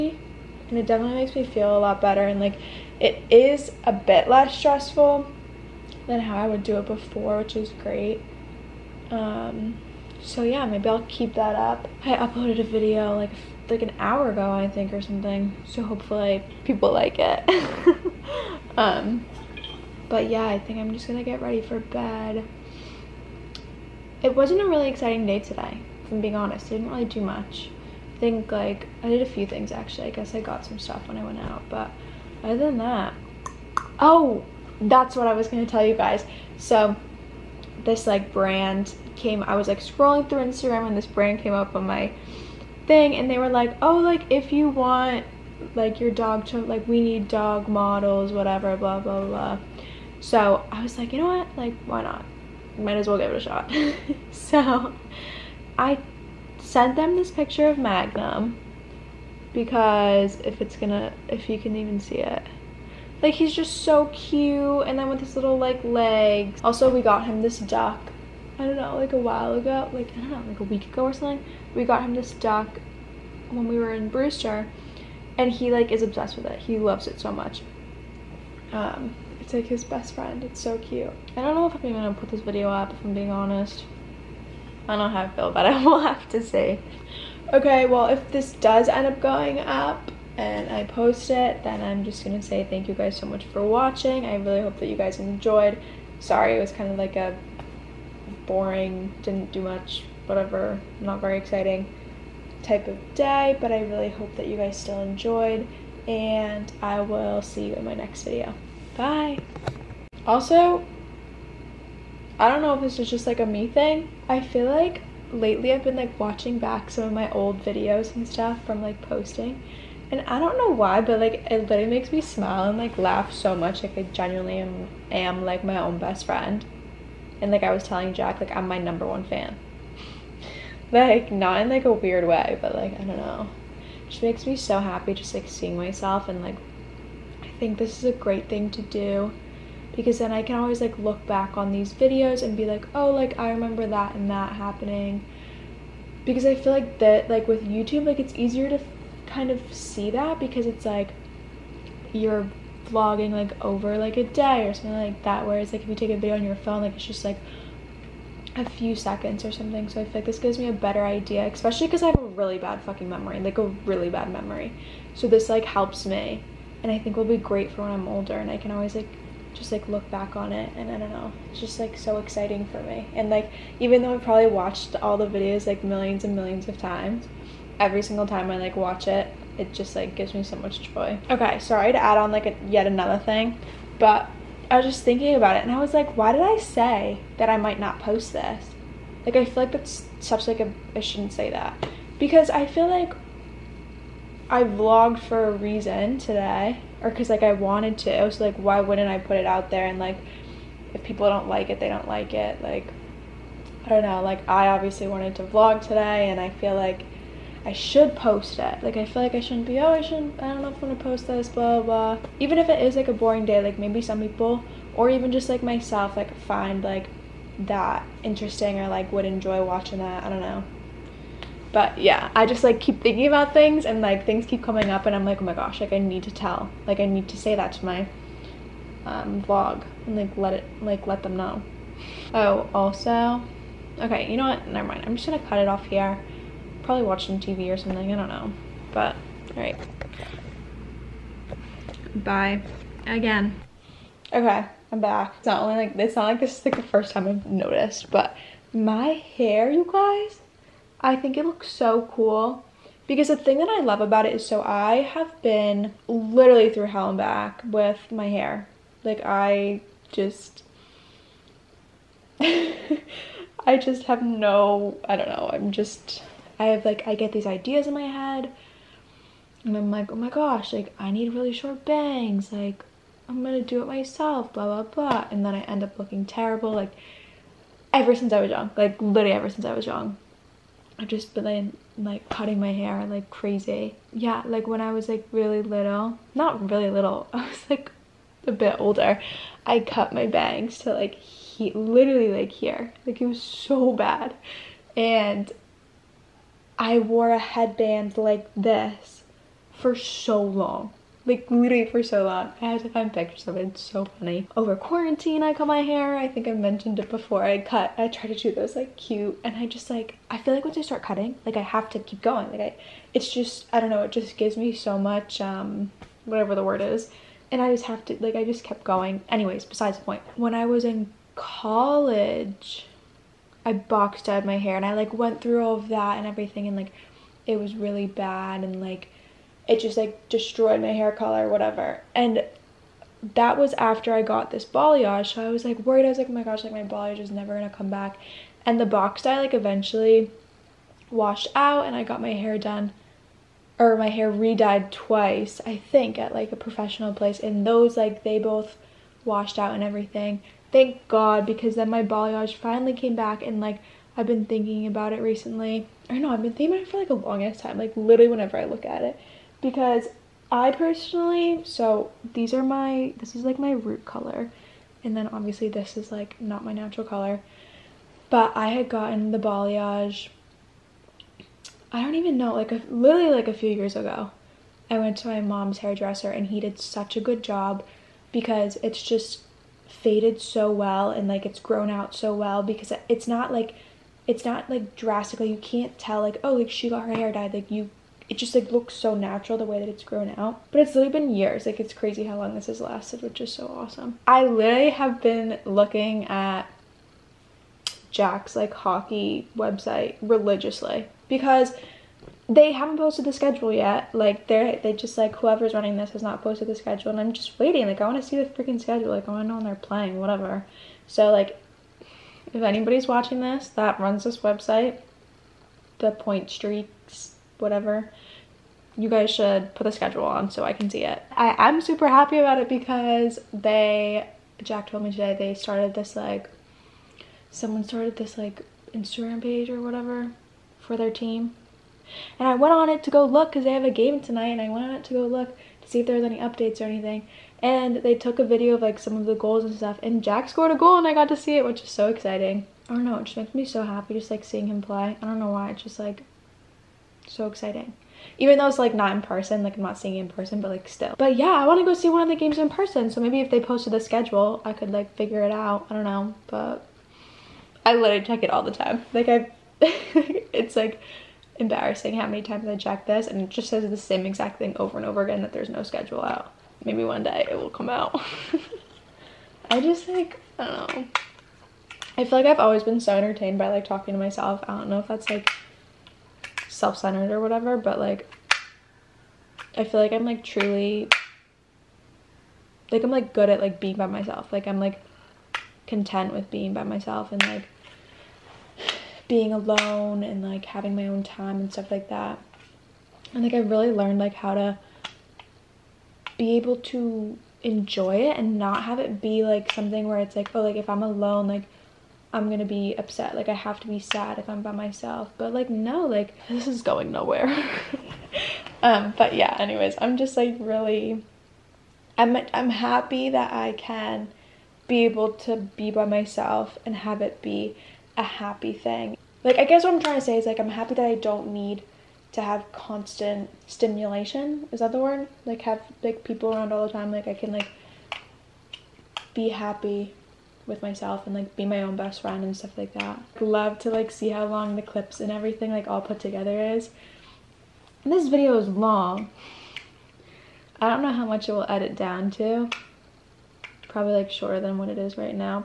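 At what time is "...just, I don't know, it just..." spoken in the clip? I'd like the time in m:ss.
5:13.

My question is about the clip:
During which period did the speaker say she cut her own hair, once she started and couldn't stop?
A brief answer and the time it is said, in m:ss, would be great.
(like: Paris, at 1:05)
Quarantine, at 5:04.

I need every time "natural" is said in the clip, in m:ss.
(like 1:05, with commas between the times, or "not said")
6:06, 6:29.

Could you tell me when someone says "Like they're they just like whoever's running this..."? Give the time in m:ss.
6:44.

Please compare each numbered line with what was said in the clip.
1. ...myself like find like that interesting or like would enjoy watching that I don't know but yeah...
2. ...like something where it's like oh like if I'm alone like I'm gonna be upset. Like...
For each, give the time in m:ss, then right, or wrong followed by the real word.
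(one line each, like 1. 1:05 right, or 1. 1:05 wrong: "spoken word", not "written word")
1. 3:35 right
2. 8:19 right.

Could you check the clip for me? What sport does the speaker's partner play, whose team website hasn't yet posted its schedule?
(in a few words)
Hockey.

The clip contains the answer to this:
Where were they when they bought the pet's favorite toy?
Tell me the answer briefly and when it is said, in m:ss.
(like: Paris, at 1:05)
Brewster, at 1:14.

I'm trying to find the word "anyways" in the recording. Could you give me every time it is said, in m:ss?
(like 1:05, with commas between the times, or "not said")
5:19, 8:29.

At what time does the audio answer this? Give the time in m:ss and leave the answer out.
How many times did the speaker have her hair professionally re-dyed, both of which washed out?
5:44.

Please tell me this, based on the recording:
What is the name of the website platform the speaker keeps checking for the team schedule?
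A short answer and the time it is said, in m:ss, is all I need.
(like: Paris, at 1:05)
Pointstreak, at 6:56.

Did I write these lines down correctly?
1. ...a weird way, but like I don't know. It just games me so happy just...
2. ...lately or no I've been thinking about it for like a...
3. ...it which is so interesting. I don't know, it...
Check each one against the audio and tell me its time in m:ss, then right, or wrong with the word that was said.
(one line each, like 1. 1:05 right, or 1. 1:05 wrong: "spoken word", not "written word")
1. 2:11 wrong: "makes", not "games"
2. 5:55 wrong: "recently", not "lately"
3. 7:21 wrong: "exciting", not "interesting".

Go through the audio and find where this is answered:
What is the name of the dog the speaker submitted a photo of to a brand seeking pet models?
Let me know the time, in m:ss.
0:57.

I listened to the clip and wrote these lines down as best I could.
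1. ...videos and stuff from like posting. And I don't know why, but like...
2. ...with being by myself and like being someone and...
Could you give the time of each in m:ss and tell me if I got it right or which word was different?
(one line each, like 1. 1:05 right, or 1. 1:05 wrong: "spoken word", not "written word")
1. 1:57 right
2. 8:06 wrong: "alone", not "someone".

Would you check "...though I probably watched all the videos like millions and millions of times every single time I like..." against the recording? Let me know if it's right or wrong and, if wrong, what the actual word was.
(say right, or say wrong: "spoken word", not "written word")
right.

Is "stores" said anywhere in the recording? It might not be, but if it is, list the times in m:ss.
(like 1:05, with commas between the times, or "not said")
not said.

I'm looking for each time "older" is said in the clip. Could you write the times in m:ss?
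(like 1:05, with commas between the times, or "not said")
2:48, 4:48.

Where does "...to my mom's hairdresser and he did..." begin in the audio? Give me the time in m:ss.
6:15.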